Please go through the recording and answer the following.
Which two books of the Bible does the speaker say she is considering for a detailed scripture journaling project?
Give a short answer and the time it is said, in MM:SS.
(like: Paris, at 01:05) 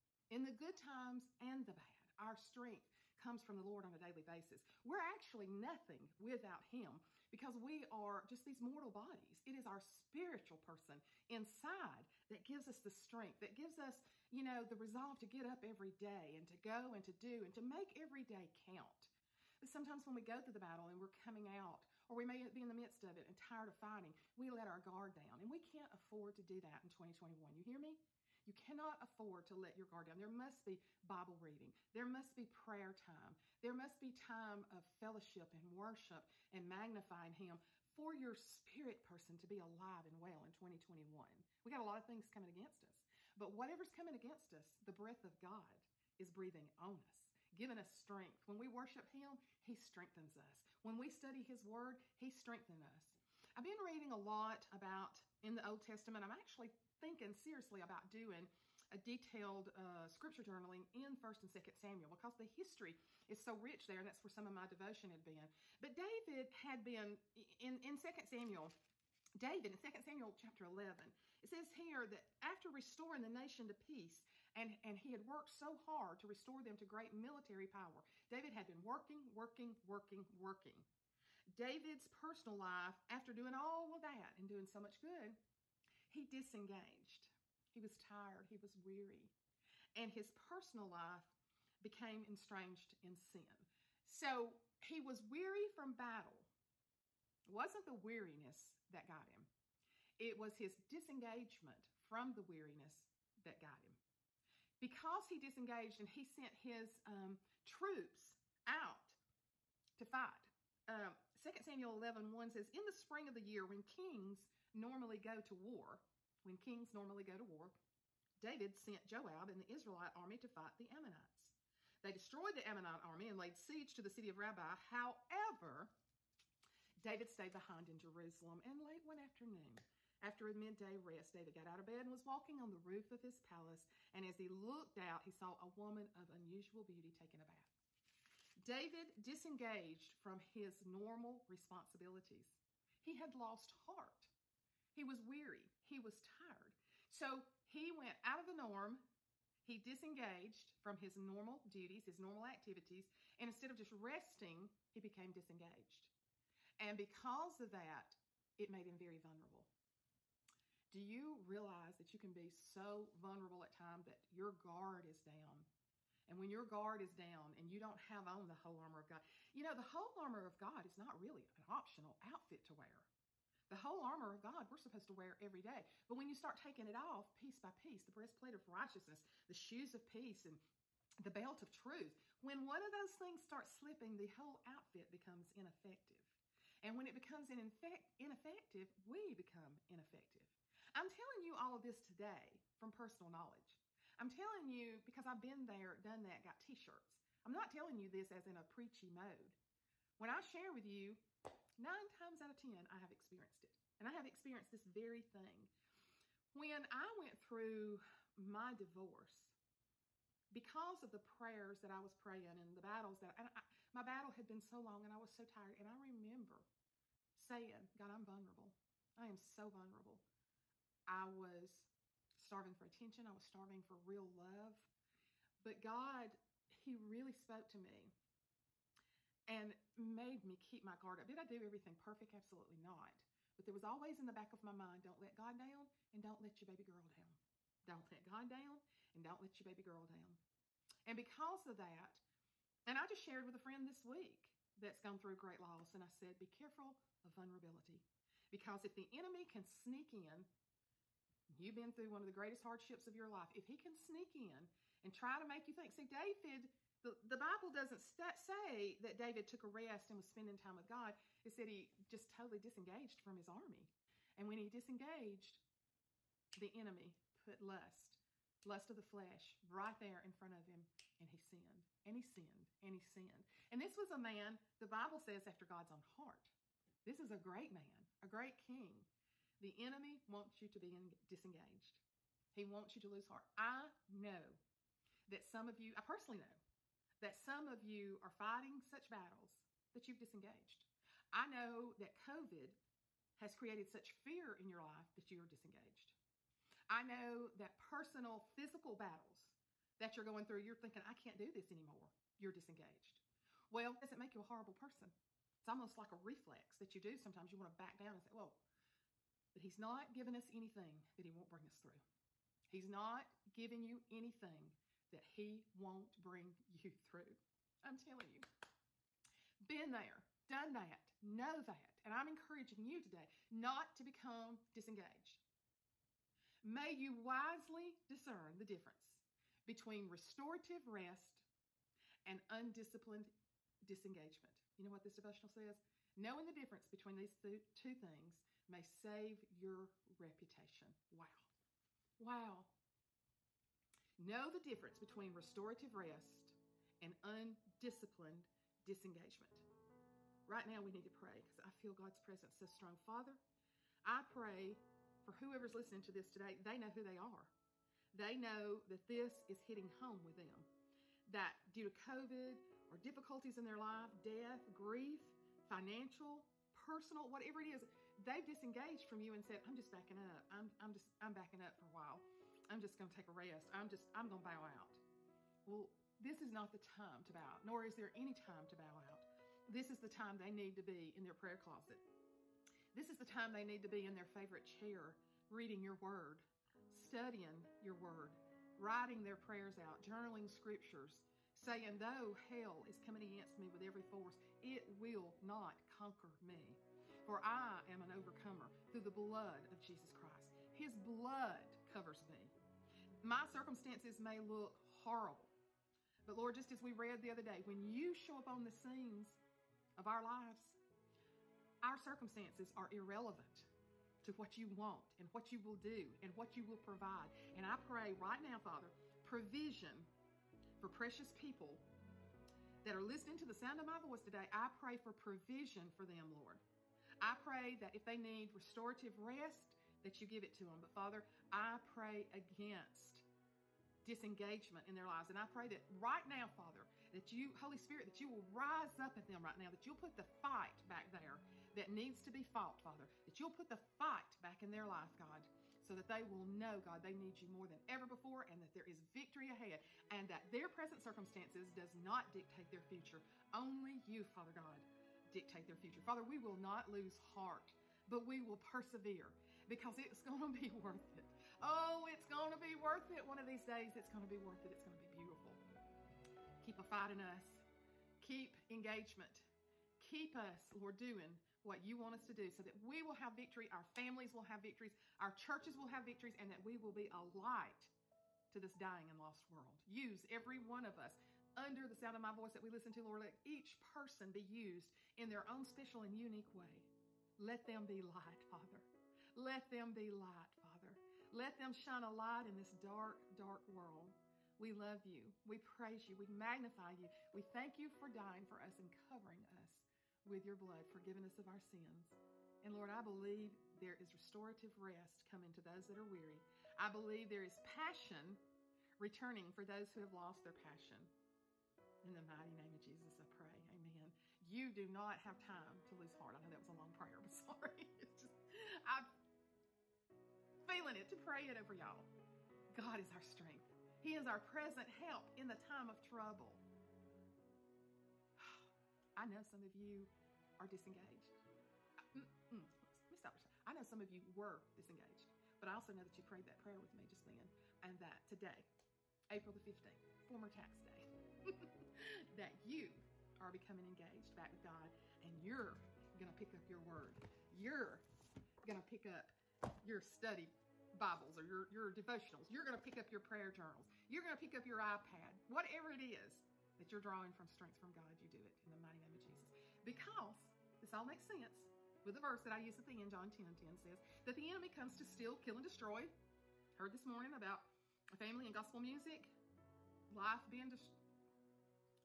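1st and 2nd Samuel, at 01:01.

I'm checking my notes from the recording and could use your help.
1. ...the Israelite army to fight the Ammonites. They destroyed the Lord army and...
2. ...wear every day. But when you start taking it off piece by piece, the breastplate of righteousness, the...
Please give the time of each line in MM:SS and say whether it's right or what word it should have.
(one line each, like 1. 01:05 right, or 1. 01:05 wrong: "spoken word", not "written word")
1. 01:59 wrong: "Ammonite", not "Lord"
2. 02:55 right.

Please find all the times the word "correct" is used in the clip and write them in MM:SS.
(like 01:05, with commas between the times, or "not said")
not said.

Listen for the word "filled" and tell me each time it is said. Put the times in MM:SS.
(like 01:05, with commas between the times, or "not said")
not said.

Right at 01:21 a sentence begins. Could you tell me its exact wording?
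David's personal life, after doing all of that and doing so much good, he disengaged.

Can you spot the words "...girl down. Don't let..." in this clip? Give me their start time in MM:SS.
03:56.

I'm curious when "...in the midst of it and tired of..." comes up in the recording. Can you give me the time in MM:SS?
00:22.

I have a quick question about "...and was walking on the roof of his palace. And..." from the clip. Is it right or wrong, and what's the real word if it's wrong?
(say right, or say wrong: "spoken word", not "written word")
right.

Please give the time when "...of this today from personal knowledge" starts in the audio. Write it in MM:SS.
03:11.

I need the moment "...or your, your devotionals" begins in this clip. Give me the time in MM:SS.
09:11.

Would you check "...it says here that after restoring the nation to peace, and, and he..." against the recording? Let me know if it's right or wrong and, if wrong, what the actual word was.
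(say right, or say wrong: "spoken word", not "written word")
right.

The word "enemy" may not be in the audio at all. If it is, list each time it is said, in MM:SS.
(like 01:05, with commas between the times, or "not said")
04:09, 04:26, 04:39, 09:24.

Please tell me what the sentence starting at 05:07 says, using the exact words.
You want to back down and say, well, but he's not giving us anything that he won't bring us through.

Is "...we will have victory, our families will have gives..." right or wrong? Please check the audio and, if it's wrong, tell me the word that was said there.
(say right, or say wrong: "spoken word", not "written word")
wrong: "victories", not "gives".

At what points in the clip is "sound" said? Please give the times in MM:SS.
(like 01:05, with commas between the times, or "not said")
07:03, 08:01.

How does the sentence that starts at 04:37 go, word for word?
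This is a great man, a great king.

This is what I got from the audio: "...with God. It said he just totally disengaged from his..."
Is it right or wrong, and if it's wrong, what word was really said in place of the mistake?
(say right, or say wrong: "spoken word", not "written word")
right.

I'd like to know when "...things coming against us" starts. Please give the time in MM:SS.
00:42.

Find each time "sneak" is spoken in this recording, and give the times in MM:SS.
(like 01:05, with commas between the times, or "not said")
04:09, 04:13.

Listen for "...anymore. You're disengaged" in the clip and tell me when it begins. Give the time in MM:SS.
05:01.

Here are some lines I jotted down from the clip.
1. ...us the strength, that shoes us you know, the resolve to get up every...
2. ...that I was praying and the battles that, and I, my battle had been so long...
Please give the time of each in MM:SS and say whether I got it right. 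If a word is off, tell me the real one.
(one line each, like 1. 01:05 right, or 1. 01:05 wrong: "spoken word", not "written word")
1. 00:12 wrong: "gives", not "shoes"
2. 03:31 right.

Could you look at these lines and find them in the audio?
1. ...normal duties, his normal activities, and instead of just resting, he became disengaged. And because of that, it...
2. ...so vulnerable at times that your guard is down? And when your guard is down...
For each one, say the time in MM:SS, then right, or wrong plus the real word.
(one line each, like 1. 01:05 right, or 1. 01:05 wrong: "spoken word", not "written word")
1. 02:31 right
2. 02:42 right.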